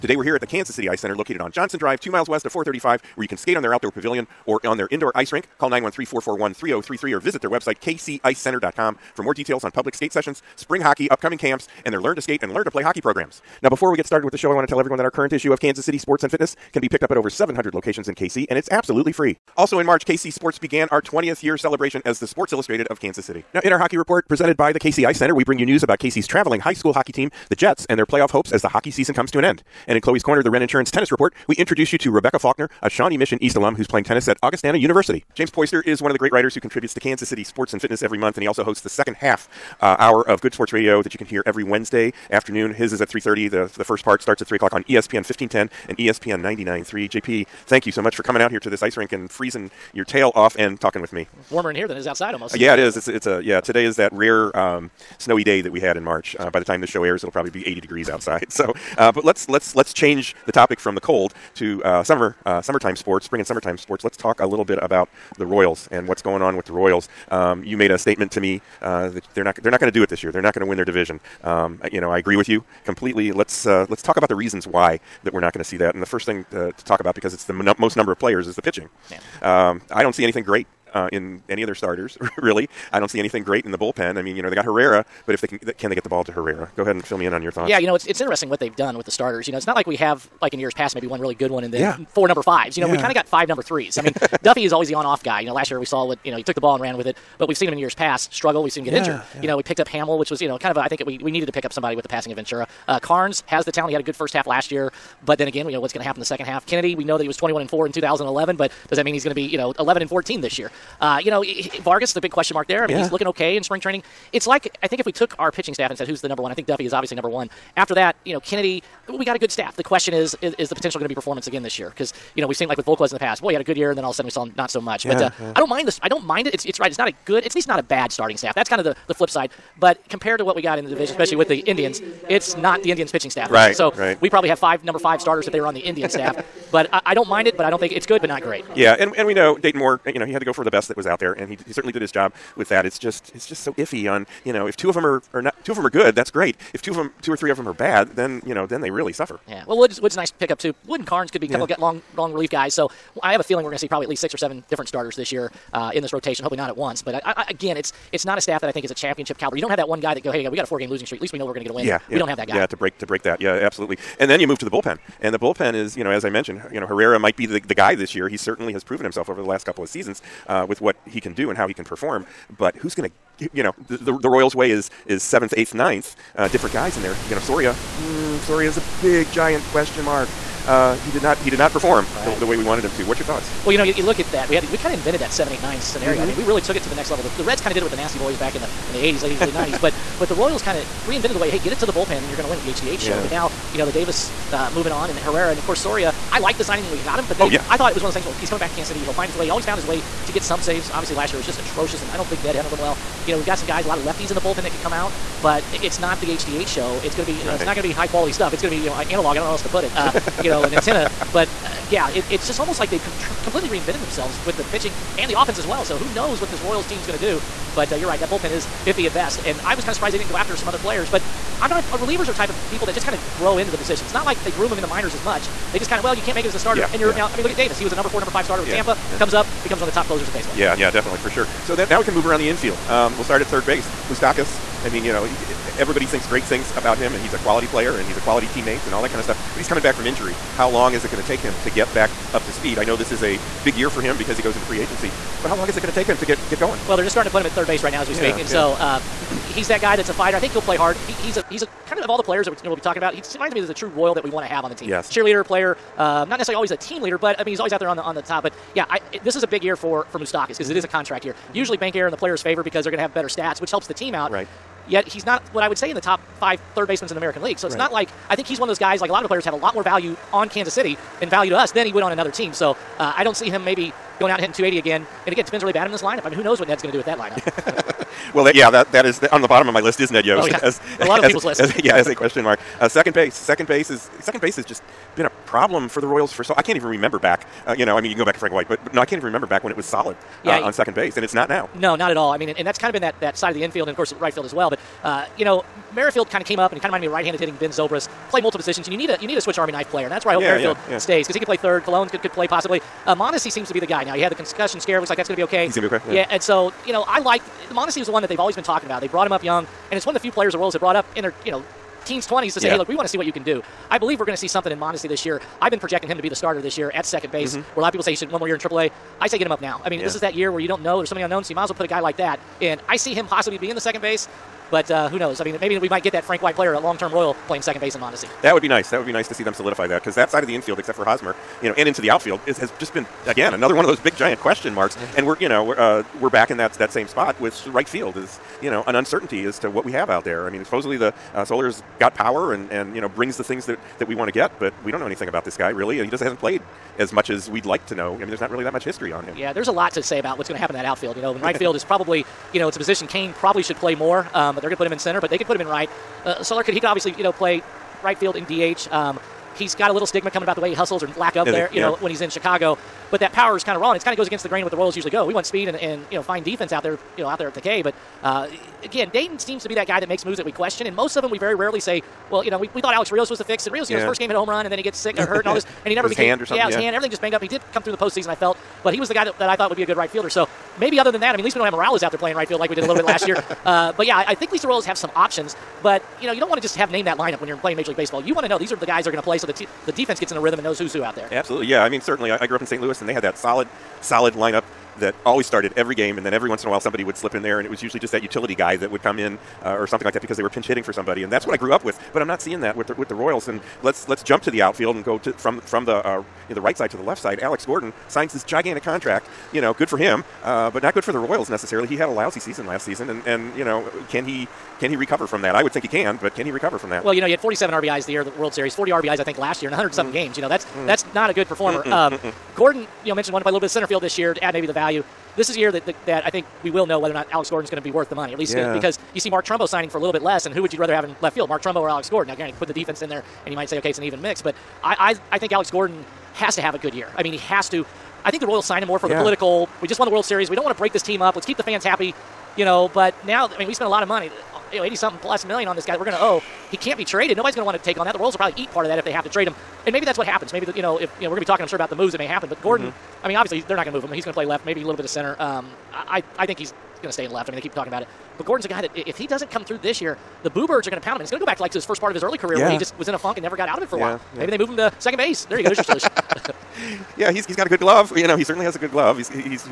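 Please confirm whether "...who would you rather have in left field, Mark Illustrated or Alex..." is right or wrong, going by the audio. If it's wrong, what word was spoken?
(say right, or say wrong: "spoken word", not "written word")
wrong: "Trumbo", not "Illustrated".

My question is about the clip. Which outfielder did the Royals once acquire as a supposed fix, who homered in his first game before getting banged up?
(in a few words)
Alex Rios.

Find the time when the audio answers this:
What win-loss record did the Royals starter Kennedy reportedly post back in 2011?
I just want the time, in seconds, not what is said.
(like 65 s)
107 s.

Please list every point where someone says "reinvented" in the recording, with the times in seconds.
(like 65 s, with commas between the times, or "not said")
191 s, 213 s.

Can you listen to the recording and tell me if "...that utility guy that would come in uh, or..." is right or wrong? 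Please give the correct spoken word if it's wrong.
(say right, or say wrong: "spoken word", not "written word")
right.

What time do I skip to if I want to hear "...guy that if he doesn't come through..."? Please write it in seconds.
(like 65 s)
458 s.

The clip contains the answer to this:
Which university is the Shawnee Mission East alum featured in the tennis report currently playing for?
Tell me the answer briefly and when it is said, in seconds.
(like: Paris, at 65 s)
Augustana University, at 34 s.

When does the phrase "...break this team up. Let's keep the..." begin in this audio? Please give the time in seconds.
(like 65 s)
440 s.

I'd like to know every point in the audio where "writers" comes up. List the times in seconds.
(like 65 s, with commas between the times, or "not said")
36 s.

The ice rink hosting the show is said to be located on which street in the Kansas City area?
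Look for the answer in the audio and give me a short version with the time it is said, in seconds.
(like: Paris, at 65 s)
Johnson Drive, at 1 s.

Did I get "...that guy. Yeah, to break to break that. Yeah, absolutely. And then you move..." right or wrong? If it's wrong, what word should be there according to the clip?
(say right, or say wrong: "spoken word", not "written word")
right.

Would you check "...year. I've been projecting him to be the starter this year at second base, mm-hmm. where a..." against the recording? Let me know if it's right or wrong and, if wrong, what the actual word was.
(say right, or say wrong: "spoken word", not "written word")
right.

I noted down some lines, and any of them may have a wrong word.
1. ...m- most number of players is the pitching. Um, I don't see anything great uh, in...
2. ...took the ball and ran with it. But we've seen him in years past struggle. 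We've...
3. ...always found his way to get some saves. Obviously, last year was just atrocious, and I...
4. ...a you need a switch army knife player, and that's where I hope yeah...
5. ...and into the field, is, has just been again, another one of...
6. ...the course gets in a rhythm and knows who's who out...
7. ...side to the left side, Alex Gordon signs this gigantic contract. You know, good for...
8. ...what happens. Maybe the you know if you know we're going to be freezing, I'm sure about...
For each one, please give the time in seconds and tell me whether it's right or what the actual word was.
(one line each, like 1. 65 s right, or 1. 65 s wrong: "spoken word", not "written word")
1. 77 s right
2. 96 s right
3. 199 s right
4. 299 s right
5. 331 s wrong: "outfield", not "field"
6. 389 s wrong: "defense", not "course"
7. 406 s right
8. 450 s wrong: "talking", not "freezing".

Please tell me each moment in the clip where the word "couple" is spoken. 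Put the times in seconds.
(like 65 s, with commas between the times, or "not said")
151 s, 169 s.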